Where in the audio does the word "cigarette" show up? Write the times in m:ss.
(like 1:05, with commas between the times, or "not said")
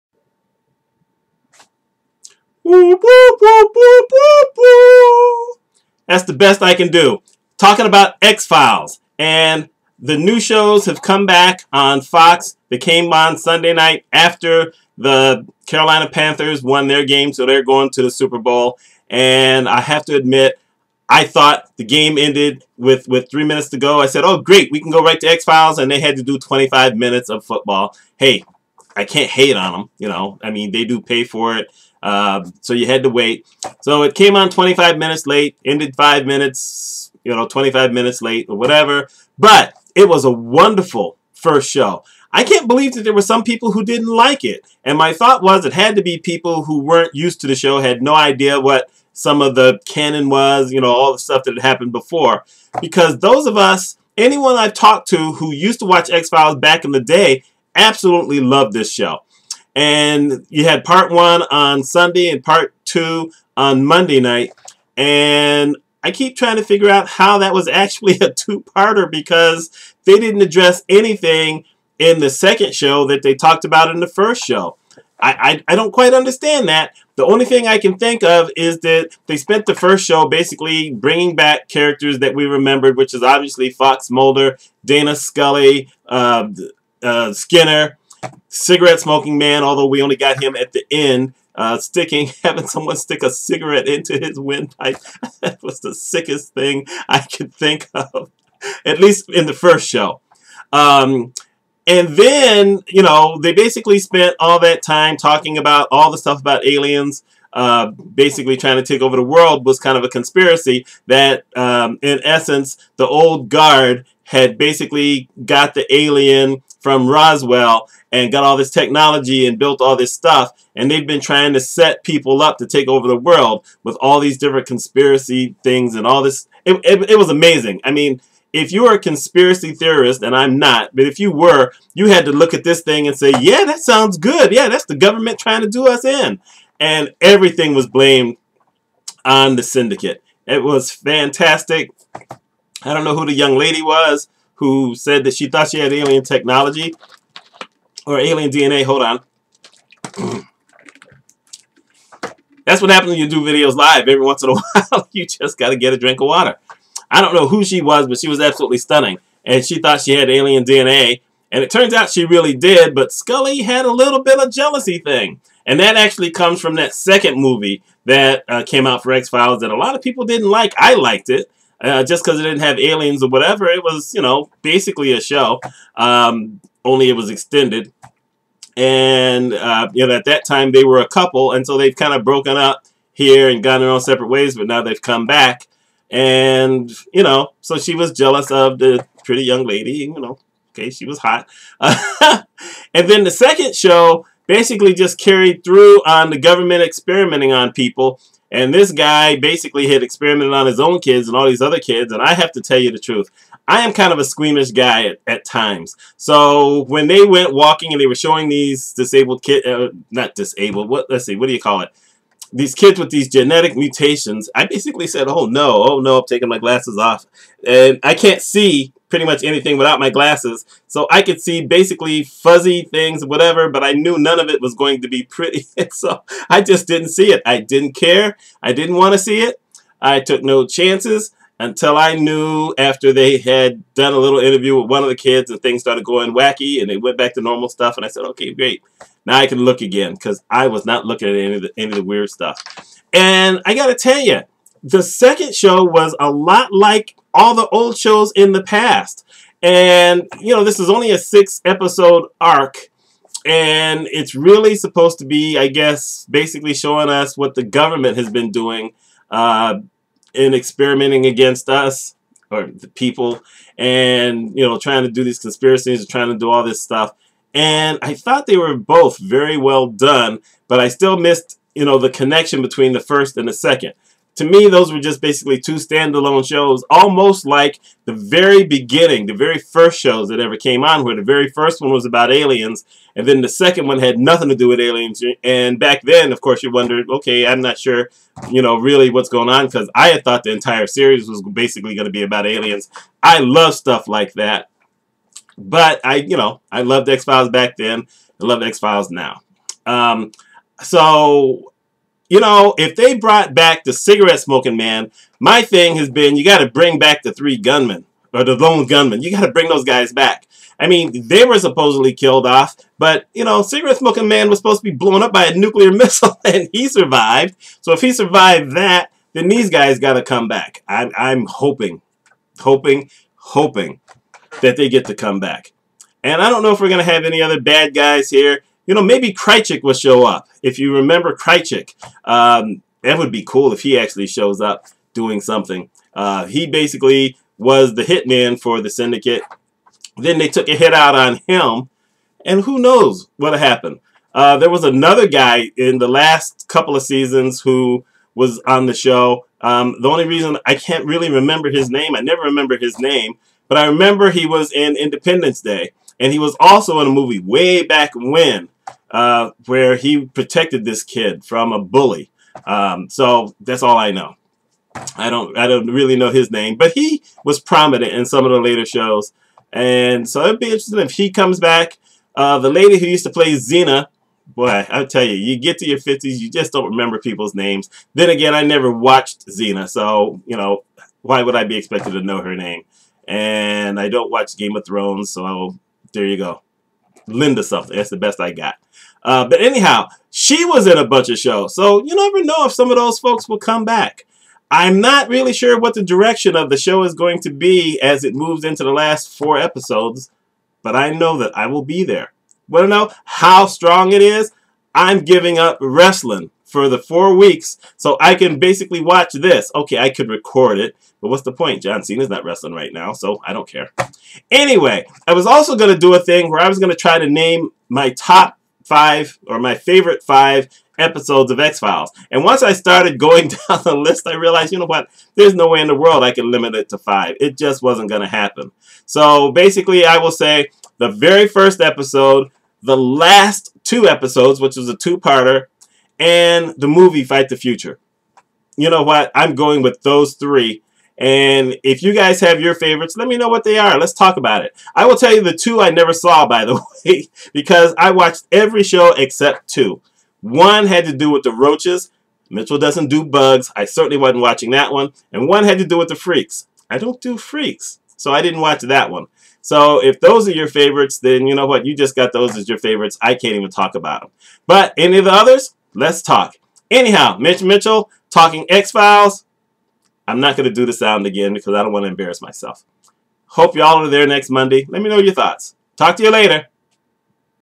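1:28, 1:33, 5:03, 5:13.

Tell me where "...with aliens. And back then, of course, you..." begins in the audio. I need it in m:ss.
4:44.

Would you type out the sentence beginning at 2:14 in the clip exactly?
Yeah, that's the government trying to do us in.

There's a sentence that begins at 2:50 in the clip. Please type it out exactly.
I liked it uh, just because it didn't have aliens or whatever.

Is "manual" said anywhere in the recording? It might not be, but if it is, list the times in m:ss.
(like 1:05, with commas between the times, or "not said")
not said.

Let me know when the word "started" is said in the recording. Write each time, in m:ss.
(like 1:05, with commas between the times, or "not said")
3:55, 7:02.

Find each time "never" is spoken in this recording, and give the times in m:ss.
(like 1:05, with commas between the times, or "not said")
5:52, 6:18, 6:32, 7:25.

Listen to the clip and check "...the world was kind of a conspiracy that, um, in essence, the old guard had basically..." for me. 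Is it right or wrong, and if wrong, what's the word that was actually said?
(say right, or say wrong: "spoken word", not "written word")
right.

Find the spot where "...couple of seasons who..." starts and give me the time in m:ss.
5:46.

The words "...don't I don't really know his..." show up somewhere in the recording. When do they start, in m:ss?
6:05.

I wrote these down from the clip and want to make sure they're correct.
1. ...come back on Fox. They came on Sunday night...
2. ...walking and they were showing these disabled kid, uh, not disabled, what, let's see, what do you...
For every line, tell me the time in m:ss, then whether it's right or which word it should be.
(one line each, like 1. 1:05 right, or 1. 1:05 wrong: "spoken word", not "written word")
1. 0:11 right
2. 3:27 right.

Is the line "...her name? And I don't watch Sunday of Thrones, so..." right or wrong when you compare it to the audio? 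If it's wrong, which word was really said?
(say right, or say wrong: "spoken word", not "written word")
wrong: "Game", not "Sunday".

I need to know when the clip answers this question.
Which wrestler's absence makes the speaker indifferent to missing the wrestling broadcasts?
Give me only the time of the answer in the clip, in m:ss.
6:51.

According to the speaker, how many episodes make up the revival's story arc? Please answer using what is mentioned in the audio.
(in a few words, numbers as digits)
6.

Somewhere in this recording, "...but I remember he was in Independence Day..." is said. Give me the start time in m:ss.
5:53.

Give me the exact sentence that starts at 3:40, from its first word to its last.
So I could see basically fuzzy things, whatever, but I knew none of it was going to be pretty.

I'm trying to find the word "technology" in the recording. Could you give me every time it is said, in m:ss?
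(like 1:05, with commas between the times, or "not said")
1:58, 2:26.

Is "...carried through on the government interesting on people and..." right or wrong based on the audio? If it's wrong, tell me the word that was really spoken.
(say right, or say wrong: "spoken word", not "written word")
wrong: "experimenting", not "interesting".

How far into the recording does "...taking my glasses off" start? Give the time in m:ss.
3:36.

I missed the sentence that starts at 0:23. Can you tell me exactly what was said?
I said, oh, great, we can go right to X-Files, and they had to do 25 minutes of football.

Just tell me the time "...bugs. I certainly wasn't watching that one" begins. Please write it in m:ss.
7:33.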